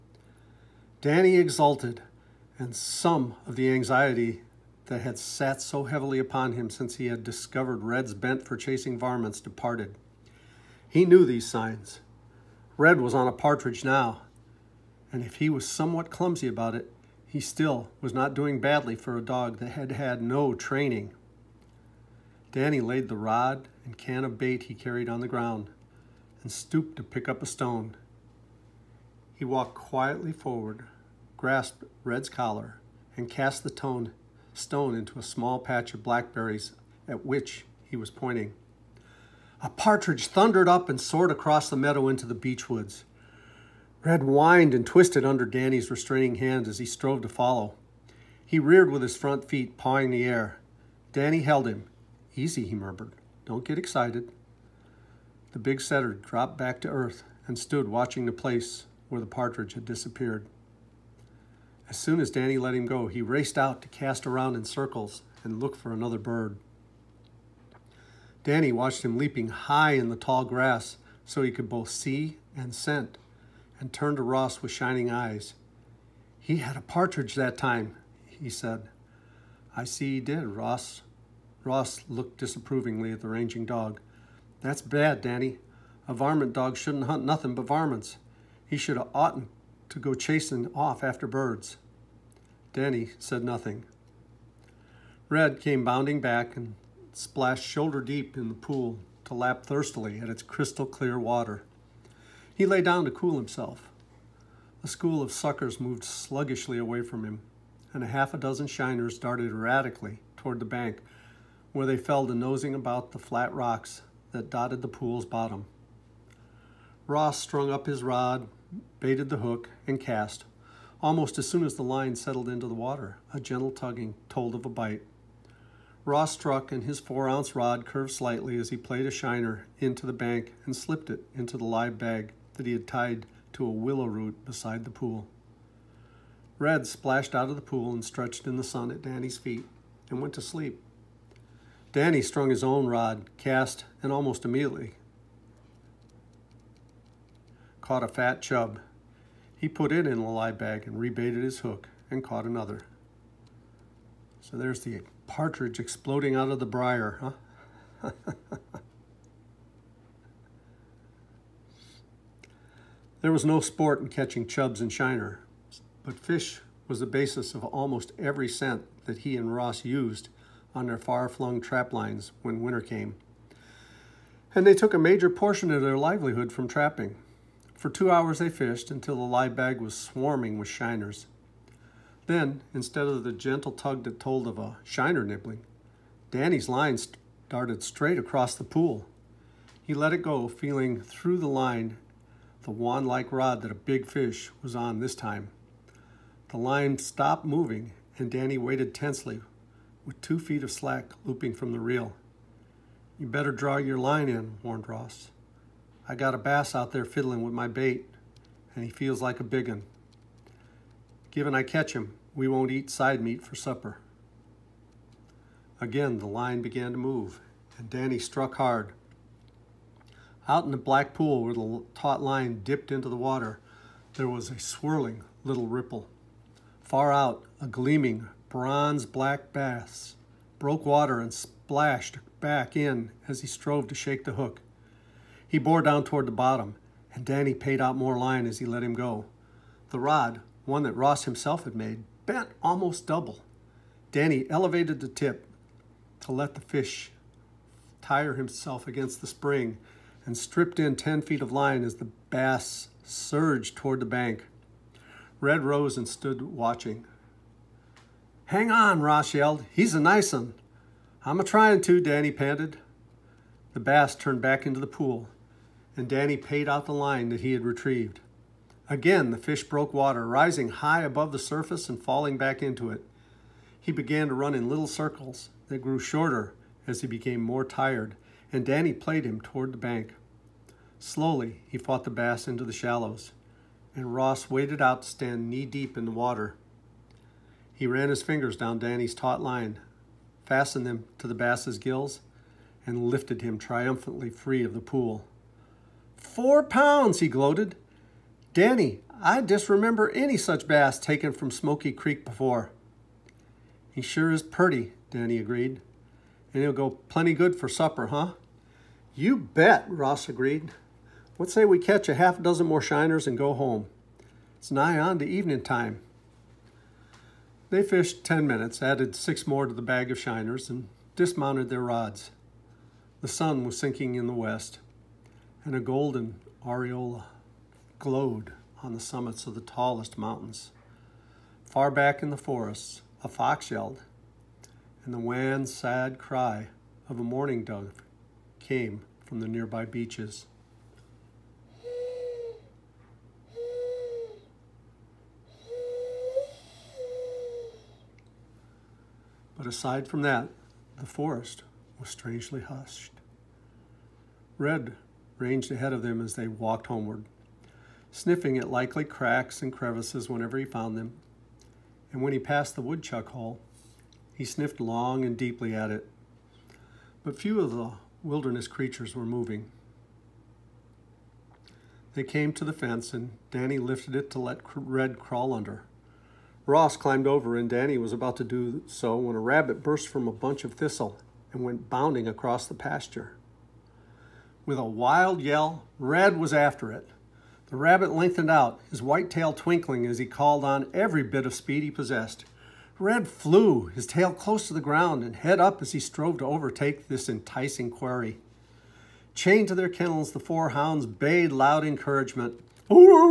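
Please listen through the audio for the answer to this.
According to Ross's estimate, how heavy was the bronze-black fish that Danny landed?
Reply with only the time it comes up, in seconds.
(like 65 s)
296 s.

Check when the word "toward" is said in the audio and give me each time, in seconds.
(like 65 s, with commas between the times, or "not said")
110 s, 236 s, 253 s, 279 s.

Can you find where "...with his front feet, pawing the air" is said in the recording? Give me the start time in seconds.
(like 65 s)
48 s.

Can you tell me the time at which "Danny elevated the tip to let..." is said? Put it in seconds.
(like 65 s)
244 s.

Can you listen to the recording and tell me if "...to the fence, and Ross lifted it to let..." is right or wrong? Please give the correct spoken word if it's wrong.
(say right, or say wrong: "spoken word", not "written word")
wrong: "Danny", not "Ross".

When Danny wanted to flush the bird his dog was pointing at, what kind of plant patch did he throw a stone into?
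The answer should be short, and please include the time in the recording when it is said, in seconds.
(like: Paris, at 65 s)
blackberries, at 36 s.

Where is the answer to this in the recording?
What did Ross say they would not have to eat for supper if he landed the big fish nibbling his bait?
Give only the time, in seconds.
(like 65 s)
212 s.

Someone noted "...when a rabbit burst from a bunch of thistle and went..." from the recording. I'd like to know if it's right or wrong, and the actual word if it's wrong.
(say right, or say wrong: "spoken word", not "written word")
right.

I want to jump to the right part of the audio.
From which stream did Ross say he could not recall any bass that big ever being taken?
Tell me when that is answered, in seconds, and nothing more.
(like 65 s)
301 s.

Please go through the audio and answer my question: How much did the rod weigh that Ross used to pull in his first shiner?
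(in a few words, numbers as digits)
4 ounce.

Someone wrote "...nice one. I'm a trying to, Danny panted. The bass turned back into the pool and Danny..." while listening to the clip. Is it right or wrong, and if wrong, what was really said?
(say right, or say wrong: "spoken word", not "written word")
right.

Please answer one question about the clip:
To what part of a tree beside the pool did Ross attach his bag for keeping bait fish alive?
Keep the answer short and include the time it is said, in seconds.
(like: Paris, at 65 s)
willow root, at 133 s.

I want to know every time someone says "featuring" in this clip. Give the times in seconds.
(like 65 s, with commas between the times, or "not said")
not said.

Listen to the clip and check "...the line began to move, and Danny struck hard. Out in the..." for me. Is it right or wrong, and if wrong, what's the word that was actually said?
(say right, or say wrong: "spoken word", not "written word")
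right.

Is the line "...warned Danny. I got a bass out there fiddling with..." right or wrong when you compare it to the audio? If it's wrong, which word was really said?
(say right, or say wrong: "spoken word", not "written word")
wrong: "Ross", not "Danny".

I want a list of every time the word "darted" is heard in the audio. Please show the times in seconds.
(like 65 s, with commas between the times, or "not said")
109 s, 187 s.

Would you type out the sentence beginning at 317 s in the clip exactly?
They fished 10 minutes, added six more to the bag of shiners, and dismounted their rods.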